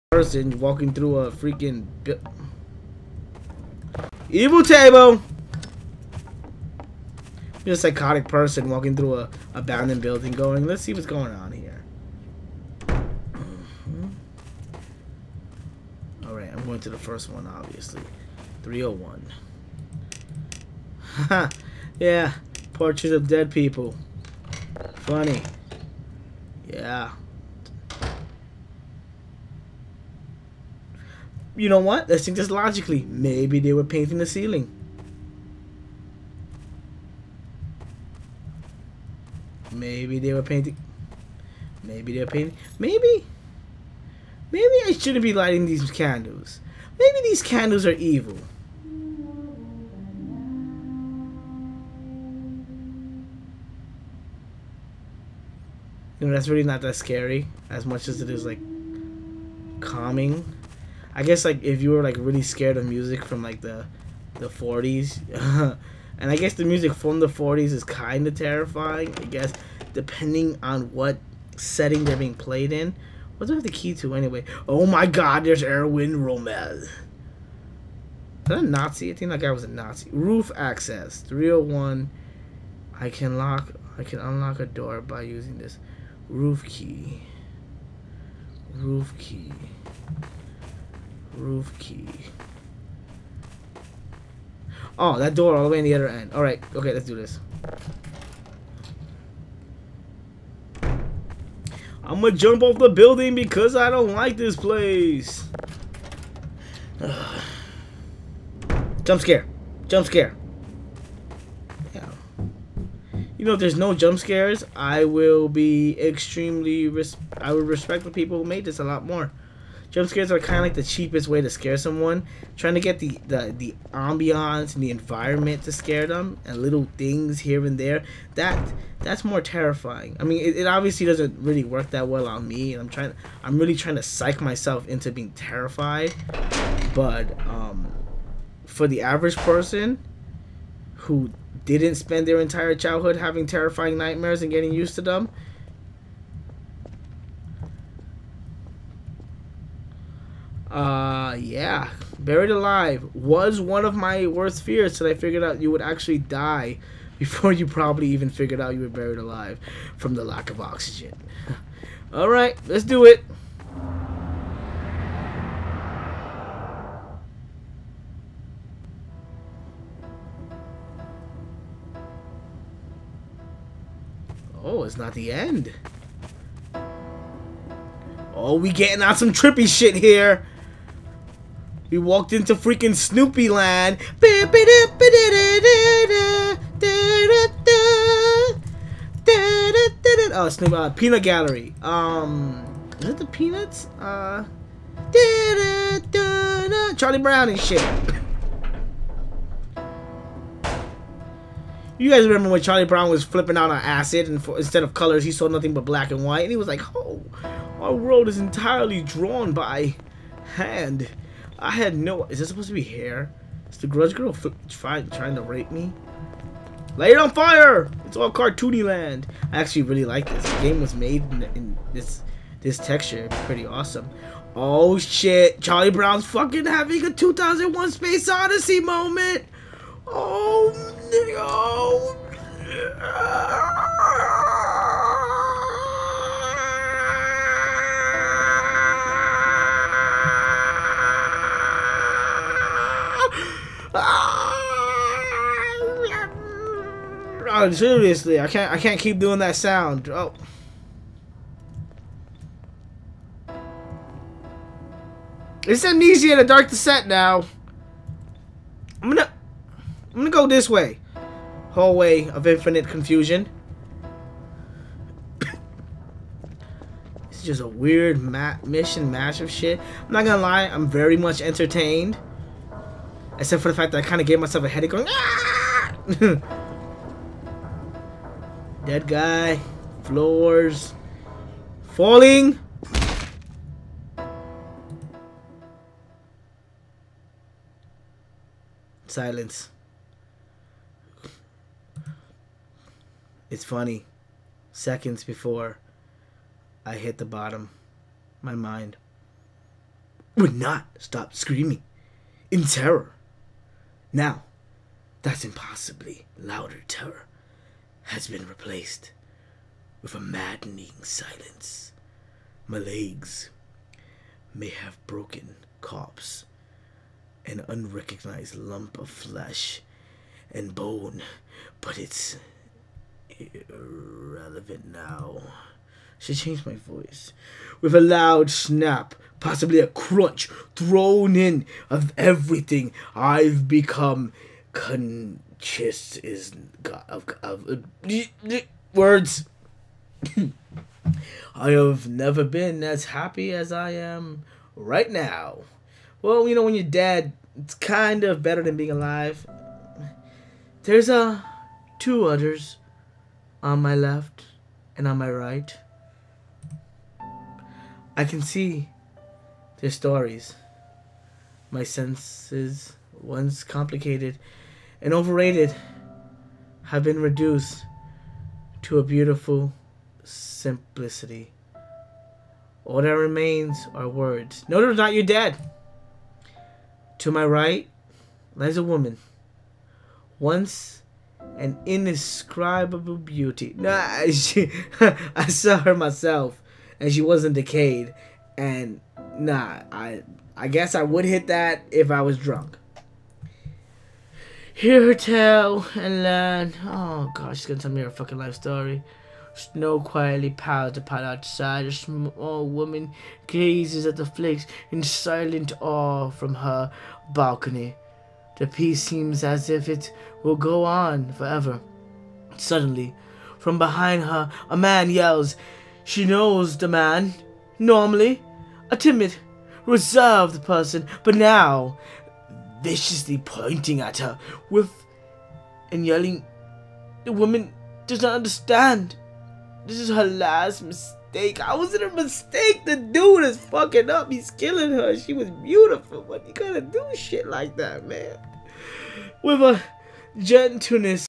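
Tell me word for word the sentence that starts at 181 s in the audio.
We walked into freaking Snoopy Land.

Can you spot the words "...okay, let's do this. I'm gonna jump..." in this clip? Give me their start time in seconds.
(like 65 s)
96 s.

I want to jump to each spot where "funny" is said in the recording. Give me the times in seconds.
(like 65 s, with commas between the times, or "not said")
24 s, 293 s.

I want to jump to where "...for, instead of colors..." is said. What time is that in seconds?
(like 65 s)
204 s.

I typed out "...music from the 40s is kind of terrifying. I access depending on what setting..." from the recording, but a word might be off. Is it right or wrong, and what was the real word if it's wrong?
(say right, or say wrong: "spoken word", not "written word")
wrong: "guess", not "access".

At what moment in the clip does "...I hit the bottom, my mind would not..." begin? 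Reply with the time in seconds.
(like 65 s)
296 s.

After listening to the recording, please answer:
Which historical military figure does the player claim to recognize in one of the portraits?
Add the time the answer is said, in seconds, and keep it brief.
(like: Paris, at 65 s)
Erwin Rommel, at 75 s.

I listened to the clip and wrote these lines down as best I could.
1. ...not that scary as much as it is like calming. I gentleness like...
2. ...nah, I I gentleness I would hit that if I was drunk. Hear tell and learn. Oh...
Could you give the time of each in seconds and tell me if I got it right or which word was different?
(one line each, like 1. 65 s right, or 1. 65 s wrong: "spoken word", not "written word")
1. 56 s wrong: "guess", not "gentleness"
2. 389 s wrong: "guess", not "gentleness".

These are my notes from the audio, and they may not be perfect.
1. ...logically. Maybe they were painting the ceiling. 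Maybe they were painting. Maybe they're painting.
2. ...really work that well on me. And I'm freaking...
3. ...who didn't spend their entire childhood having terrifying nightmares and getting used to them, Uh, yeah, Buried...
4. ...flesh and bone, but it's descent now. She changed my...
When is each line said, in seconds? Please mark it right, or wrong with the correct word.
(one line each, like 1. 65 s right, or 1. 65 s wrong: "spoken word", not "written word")
1. 32 s right
2. 131 s wrong: "trying", not "freaking"
3. 140 s right
4. 319 s wrong: "irrelevant", not "descent".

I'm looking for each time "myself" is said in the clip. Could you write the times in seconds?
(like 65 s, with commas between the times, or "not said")
134 s, 274 s, 385 s.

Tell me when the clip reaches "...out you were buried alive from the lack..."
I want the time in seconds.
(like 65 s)
158 s.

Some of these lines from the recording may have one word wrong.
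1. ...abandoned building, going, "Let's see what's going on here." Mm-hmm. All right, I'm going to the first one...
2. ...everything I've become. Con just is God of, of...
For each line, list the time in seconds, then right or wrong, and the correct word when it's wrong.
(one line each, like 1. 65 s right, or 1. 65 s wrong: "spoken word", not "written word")
1. 9 s right
2. 332 s right.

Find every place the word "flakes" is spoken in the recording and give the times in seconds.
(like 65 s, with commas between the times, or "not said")
404 s.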